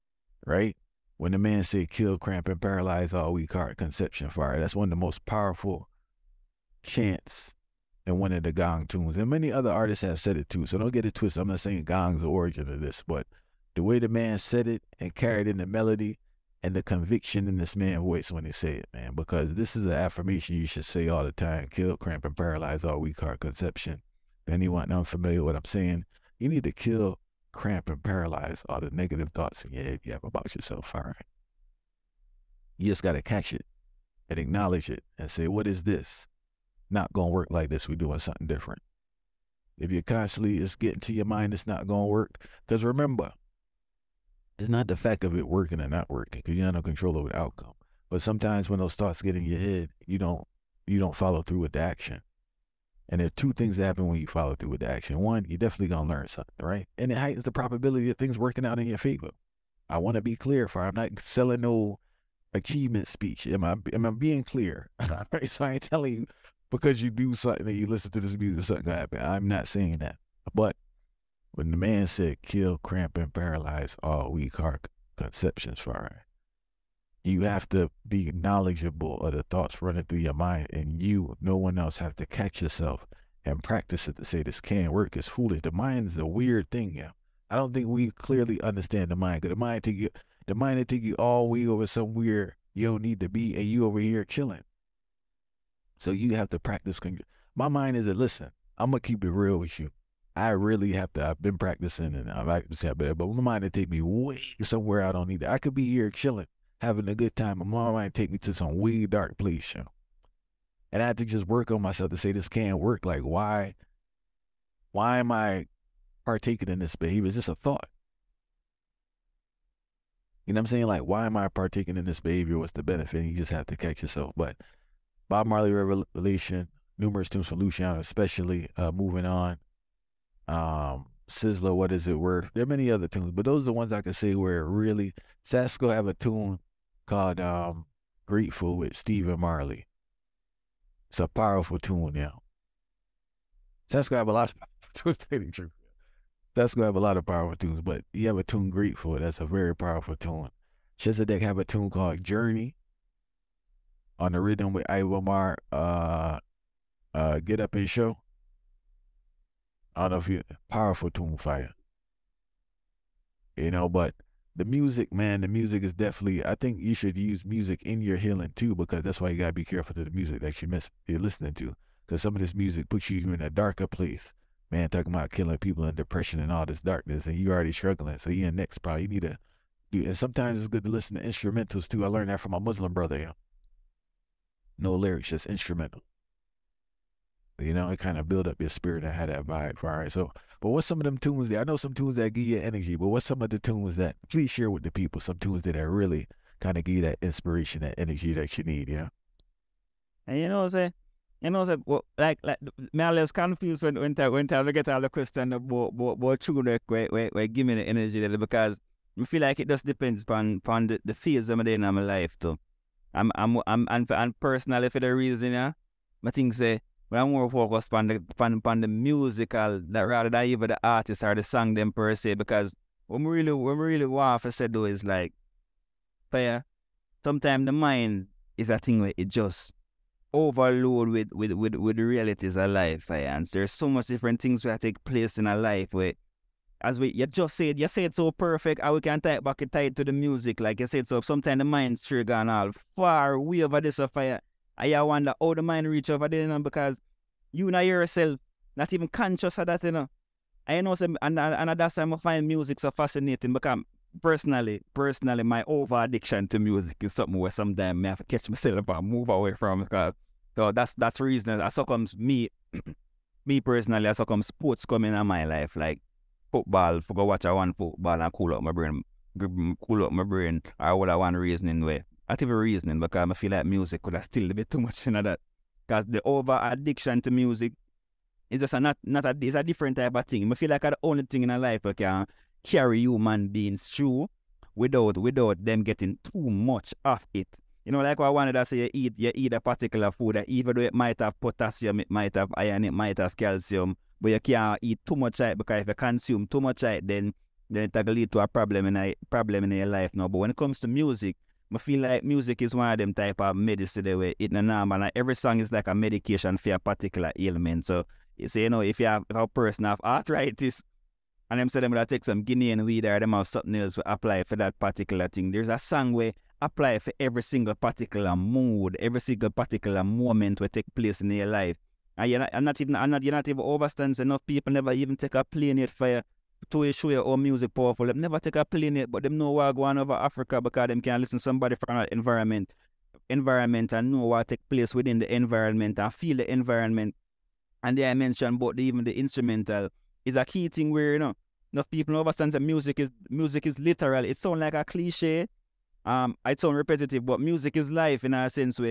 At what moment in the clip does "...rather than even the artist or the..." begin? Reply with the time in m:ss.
3:39.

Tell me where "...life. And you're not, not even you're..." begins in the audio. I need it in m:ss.
5:21.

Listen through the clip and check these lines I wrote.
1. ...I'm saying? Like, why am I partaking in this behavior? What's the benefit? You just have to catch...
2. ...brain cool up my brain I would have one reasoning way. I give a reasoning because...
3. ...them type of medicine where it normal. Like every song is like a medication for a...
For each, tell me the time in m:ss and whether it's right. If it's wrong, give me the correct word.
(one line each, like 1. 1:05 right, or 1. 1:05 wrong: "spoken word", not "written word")
1. 2:00 right
2. 4:28 right
3. 5:02 right.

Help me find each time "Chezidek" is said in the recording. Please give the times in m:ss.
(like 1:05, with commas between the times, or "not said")
2:30.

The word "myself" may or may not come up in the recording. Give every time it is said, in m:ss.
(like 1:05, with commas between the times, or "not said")
1:51, 4:18.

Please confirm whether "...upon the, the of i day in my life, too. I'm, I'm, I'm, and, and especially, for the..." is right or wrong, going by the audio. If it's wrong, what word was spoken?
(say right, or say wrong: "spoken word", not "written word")
wrong: "personally", not "especially".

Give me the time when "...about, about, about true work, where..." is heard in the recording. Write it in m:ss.
3:25.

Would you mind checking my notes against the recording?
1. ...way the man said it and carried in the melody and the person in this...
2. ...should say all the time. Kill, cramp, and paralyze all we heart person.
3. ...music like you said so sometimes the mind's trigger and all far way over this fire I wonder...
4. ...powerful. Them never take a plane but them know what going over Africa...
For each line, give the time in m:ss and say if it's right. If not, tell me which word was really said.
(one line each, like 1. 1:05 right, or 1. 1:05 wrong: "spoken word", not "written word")
1. 0:13 wrong: "conviction", not "person"
2. 0:20 wrong: "conception", not "person"
3. 4:00 right
4. 5:27 right.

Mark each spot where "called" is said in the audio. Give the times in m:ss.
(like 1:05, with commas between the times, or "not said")
2:17, 2:31.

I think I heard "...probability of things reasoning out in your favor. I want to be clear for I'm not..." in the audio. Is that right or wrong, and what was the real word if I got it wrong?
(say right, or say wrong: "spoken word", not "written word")
wrong: "working", not "reasoning".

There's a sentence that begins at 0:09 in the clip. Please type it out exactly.
And many other artists have said it too.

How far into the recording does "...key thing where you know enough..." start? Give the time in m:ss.
5:40.